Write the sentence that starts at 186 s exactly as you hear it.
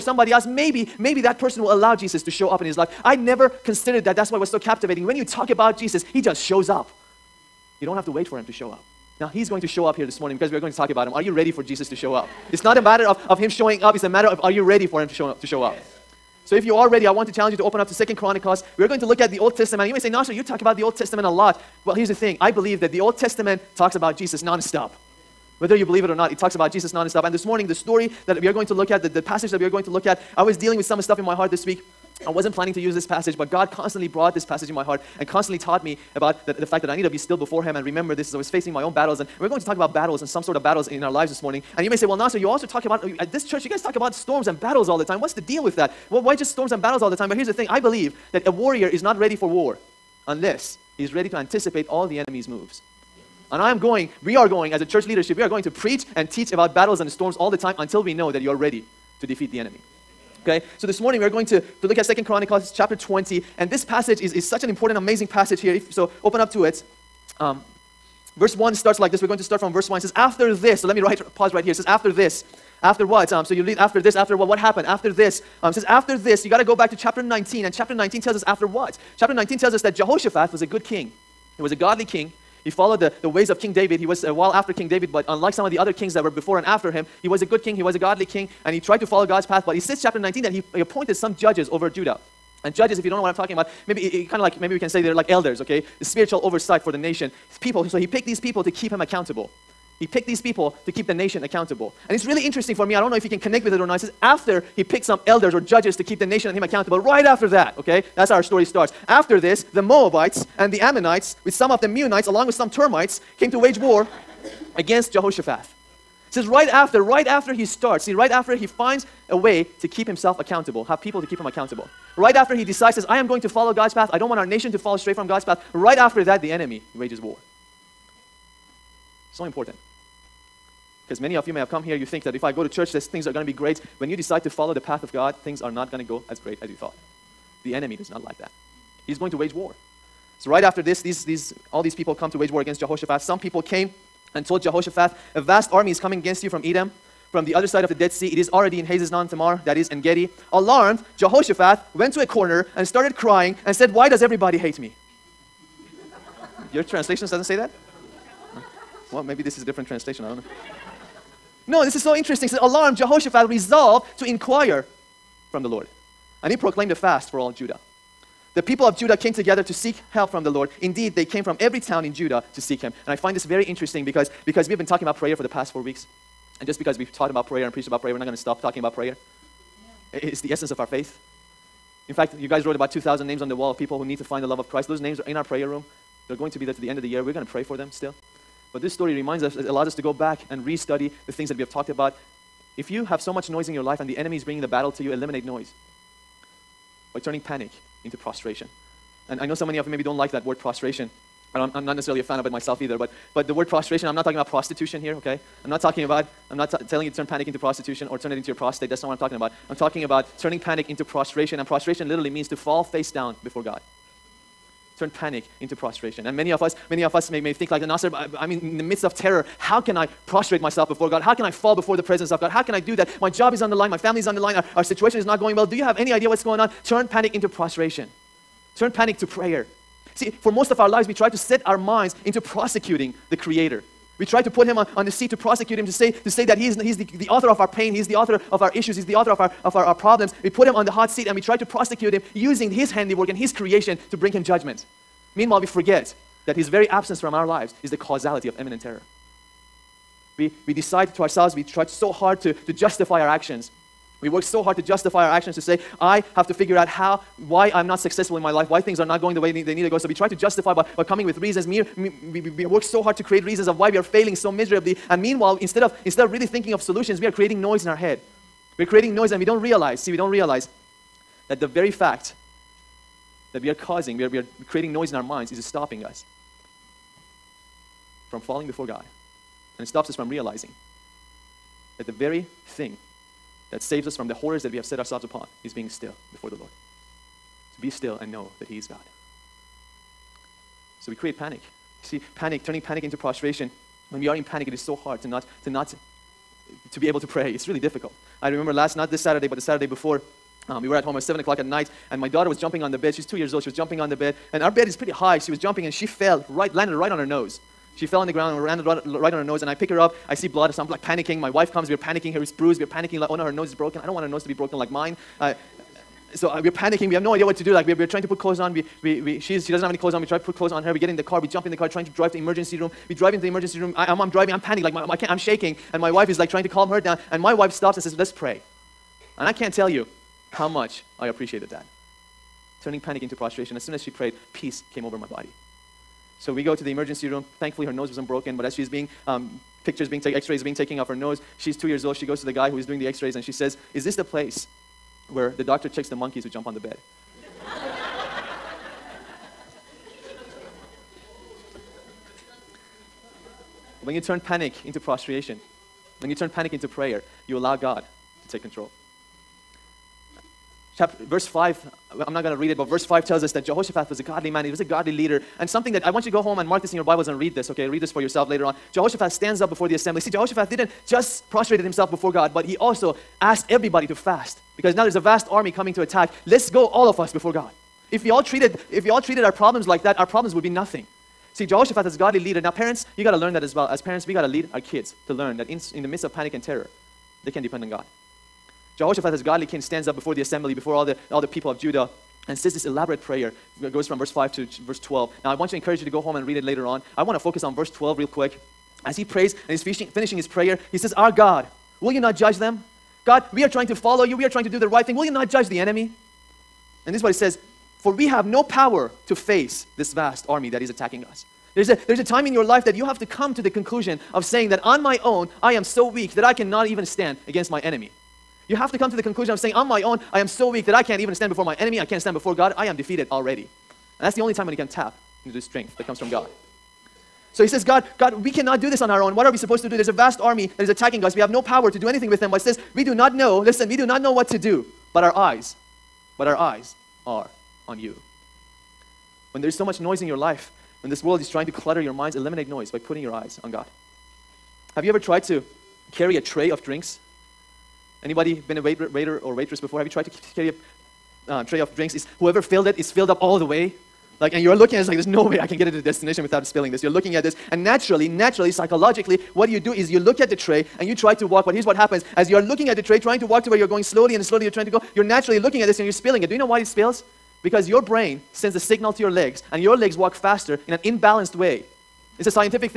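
They're going to be there to the end of the year.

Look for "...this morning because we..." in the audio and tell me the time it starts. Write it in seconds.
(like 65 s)
10 s.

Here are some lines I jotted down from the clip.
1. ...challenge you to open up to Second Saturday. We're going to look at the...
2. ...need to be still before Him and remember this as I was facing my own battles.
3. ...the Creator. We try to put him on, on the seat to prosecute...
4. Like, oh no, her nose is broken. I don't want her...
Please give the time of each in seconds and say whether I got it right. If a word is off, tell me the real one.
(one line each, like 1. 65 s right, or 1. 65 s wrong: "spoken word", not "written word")
1. 17 s wrong: "Chronicles", not "Saturday"
2. 36 s right
3. 233 s right
4. 313 s right.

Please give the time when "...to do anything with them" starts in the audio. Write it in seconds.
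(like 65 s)
431 s.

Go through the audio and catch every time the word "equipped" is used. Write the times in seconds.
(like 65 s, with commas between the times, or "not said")
not said.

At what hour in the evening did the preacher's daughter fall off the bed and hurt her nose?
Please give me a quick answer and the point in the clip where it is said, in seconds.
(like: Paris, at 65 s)
7 o'clock, at 301 s.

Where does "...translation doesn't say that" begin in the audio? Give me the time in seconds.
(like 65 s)
156 s.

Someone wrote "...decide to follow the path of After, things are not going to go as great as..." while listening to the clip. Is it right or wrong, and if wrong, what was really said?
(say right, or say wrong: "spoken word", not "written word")
wrong: "God", not "After".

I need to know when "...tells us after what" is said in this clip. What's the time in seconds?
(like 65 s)
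78 s.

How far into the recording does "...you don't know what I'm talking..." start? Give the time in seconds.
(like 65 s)
93 s.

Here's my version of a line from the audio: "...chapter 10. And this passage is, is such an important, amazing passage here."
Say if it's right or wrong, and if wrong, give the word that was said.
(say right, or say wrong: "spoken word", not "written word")
wrong: "20", not "10".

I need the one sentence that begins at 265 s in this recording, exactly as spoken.
And meanwhile, instead of, instead of really thinking of solutions, we are creating noise in our head.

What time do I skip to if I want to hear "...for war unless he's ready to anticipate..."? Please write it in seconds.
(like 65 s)
49 s.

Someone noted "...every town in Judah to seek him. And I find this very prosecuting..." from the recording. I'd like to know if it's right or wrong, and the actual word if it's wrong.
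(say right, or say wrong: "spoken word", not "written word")
wrong: "interesting", not "prosecuting".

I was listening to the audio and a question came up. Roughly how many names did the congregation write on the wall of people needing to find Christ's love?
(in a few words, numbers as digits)
2,000.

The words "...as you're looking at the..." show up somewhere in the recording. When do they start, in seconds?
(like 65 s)
462 s.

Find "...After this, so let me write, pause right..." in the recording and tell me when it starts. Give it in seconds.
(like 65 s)
70 s.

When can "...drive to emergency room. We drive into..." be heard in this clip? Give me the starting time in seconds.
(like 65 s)
322 s.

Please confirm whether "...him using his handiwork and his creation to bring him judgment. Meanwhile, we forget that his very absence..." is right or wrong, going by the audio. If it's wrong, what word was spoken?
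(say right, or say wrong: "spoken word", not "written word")
right.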